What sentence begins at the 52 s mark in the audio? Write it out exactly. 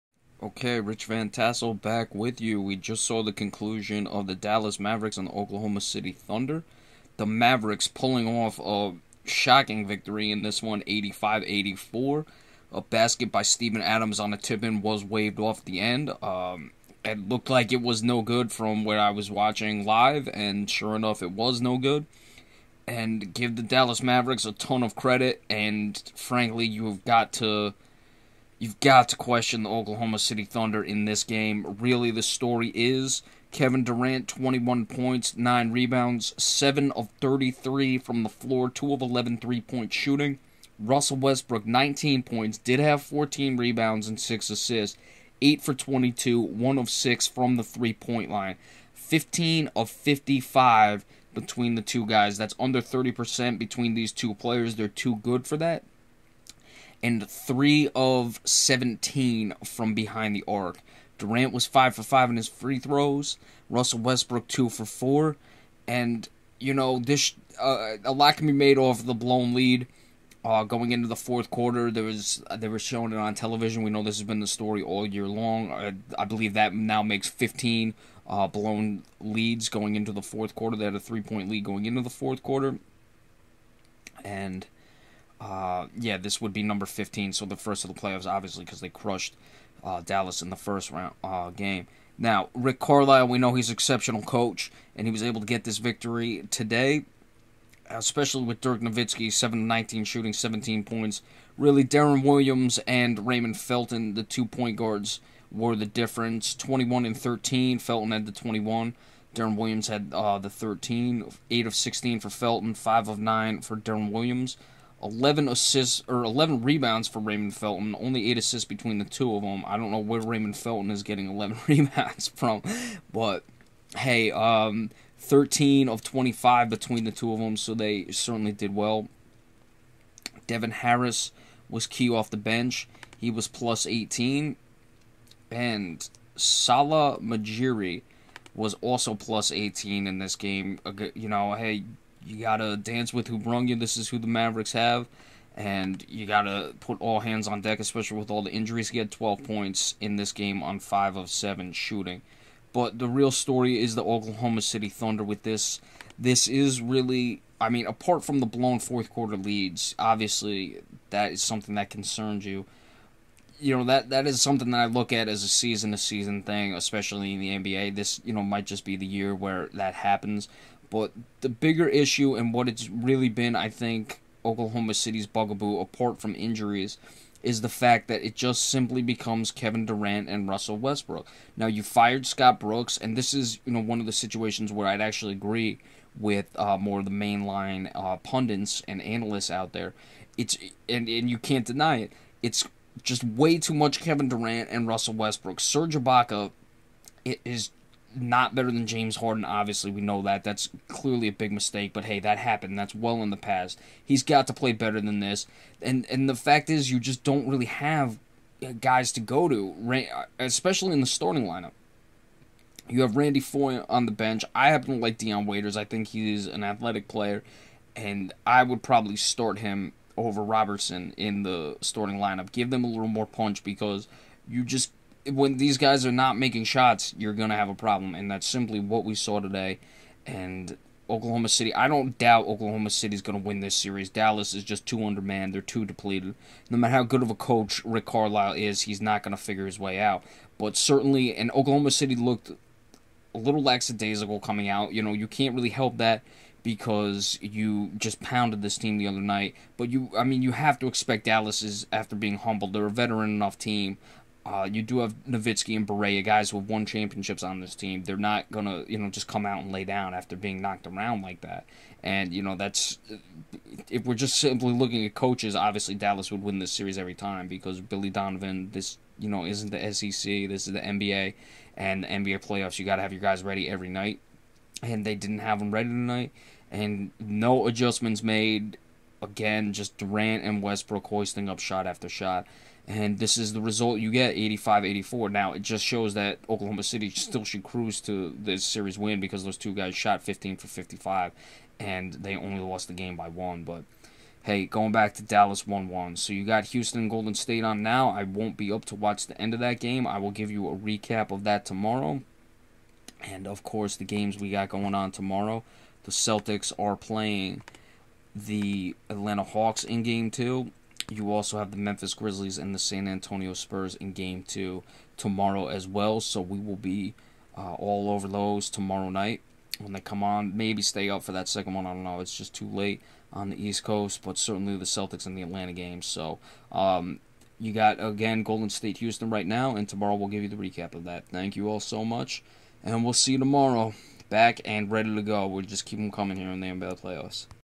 That's under 30% between these two players.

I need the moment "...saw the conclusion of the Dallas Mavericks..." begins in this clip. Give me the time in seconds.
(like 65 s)
3 s.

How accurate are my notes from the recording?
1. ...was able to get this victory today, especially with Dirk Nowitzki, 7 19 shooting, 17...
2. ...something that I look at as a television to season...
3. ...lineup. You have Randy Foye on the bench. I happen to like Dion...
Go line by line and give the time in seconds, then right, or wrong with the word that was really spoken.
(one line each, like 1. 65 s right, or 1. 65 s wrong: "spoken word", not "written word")
1. 95 s right
2. 164 s wrong: "season", not "television"
3. 211 s right.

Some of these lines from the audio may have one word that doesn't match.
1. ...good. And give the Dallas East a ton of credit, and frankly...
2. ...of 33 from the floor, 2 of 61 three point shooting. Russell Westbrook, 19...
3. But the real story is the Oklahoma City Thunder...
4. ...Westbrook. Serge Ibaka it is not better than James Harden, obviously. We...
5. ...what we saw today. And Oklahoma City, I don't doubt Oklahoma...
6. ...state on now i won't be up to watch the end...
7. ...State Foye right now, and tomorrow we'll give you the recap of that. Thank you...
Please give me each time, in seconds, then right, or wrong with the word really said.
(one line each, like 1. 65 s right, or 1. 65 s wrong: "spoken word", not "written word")
1. 21 s wrong: "Mavericks", not "East"
2. 36 s wrong: "11", not "61"
3. 152 s right
4. 195 s right
5. 228 s right
6. 297 s right
7. 328 s wrong: "Houston", not "Foye".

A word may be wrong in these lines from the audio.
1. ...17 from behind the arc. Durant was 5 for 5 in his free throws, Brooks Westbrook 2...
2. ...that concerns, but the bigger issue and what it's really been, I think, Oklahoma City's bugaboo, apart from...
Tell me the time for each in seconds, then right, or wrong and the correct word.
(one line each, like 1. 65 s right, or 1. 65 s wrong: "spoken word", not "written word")
1. 58 s wrong: "Russell", not "Brooks"
2. 169 s wrong: "happens", not "concerns".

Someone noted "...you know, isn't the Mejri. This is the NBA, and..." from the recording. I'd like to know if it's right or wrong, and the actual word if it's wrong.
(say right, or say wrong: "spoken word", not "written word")
wrong: "SEC", not "Mejri".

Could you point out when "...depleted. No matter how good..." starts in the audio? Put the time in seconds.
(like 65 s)
235 s.